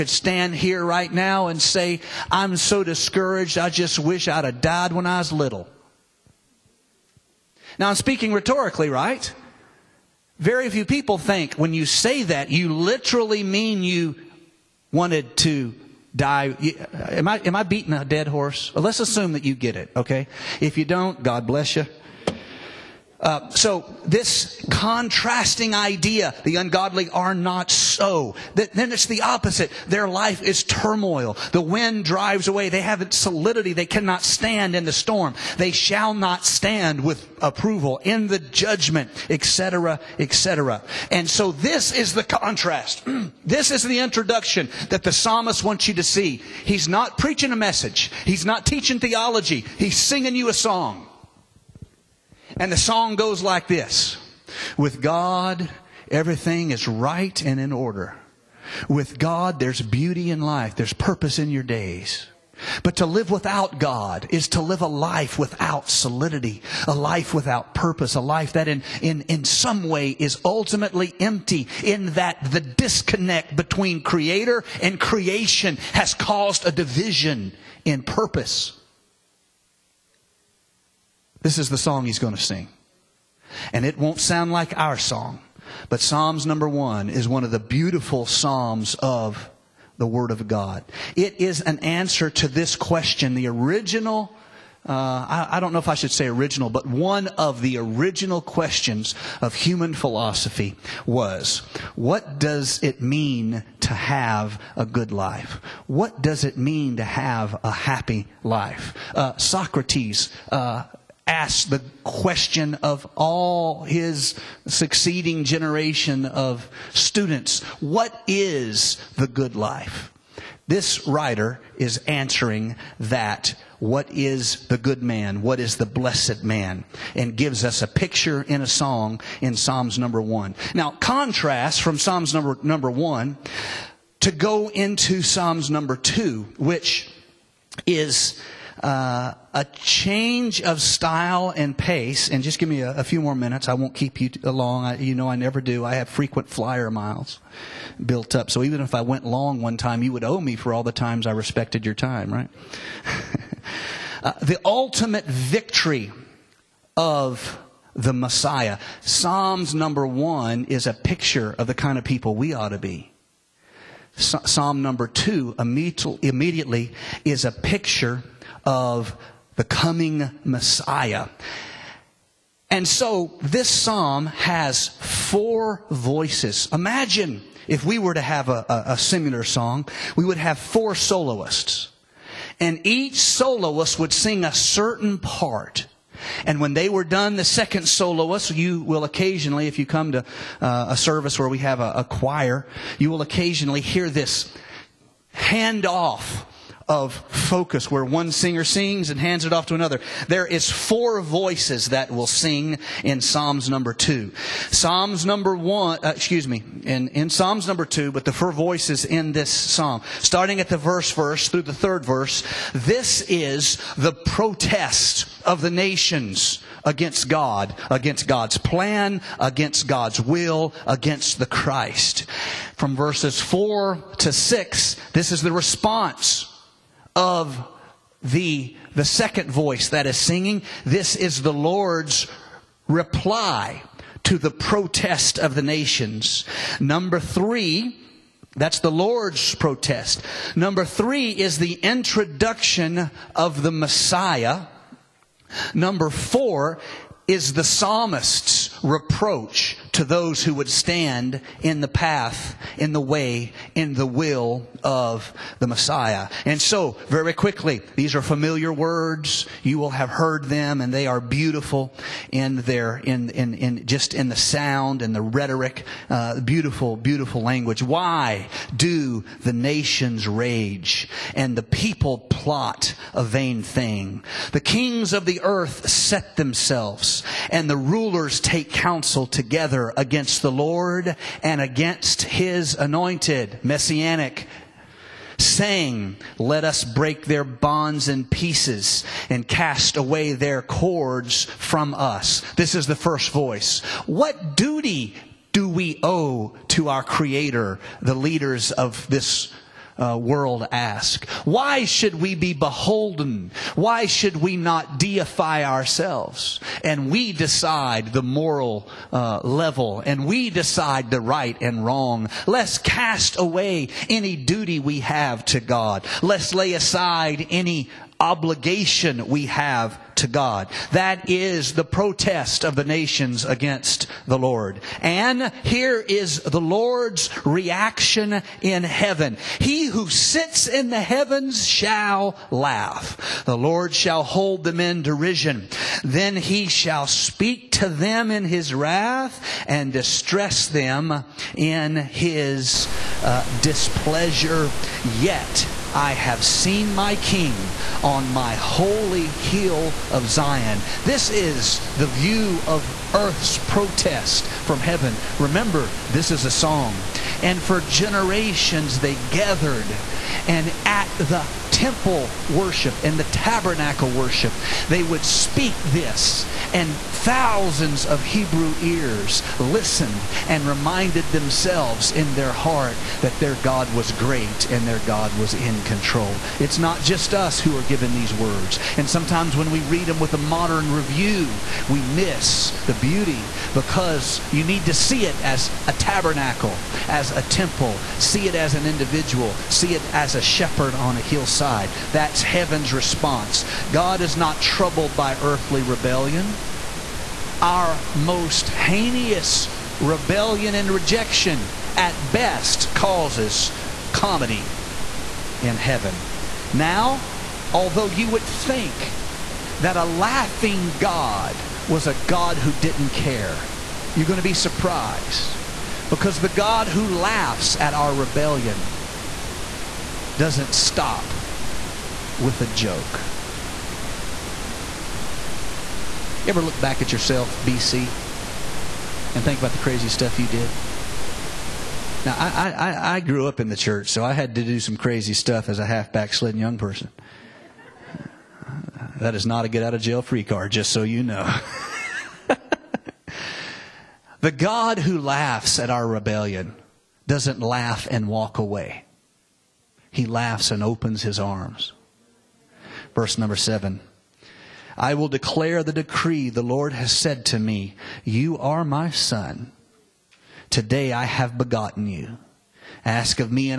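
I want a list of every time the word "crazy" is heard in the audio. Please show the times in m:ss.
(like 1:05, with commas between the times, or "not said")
7:09, 7:14.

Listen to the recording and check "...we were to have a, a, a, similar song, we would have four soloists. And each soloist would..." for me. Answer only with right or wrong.
right.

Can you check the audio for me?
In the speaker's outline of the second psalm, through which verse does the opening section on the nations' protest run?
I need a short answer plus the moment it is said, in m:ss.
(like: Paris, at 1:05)
third verse, at 3:31.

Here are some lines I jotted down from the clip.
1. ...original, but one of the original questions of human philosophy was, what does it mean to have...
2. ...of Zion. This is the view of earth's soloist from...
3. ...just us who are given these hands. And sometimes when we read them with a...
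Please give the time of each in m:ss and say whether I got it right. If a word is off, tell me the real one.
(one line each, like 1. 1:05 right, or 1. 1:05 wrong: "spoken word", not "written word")
1. 1:36 right
2. 5:50 wrong: "protest", not "soloist"
3. 6:17 wrong: "words", not "hands".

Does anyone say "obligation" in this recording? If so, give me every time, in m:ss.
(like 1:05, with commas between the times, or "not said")
5:18.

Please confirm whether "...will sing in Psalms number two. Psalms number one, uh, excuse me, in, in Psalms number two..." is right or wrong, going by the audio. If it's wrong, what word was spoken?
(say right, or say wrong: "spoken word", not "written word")
right.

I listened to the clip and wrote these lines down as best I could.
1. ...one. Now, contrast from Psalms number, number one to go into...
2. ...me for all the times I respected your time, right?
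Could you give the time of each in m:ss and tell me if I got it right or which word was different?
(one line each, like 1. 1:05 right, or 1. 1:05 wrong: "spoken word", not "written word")
1. 2:10 right
2. 2:30 right.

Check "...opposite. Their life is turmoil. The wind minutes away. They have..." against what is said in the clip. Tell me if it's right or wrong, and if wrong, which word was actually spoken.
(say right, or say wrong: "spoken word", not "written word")
wrong: "drives", not "minutes".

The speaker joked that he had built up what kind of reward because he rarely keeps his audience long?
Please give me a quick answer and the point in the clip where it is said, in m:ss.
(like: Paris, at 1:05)
frequent flyer miles, at 2:26.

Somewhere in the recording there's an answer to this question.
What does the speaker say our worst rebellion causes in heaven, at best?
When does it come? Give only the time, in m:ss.
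6:44.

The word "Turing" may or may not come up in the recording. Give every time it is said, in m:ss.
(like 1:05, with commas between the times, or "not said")
not said.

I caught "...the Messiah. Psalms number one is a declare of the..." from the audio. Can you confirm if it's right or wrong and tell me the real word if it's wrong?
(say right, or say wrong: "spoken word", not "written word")
wrong: "picture", not "declare".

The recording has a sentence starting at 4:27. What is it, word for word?
Why do the nations rage and the people plot a vain thing?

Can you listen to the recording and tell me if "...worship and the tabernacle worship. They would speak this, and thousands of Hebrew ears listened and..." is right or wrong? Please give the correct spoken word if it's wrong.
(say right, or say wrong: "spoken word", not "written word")
right.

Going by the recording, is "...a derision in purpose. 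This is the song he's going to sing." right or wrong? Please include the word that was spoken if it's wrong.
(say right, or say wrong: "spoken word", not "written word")
wrong: "division", not "derision".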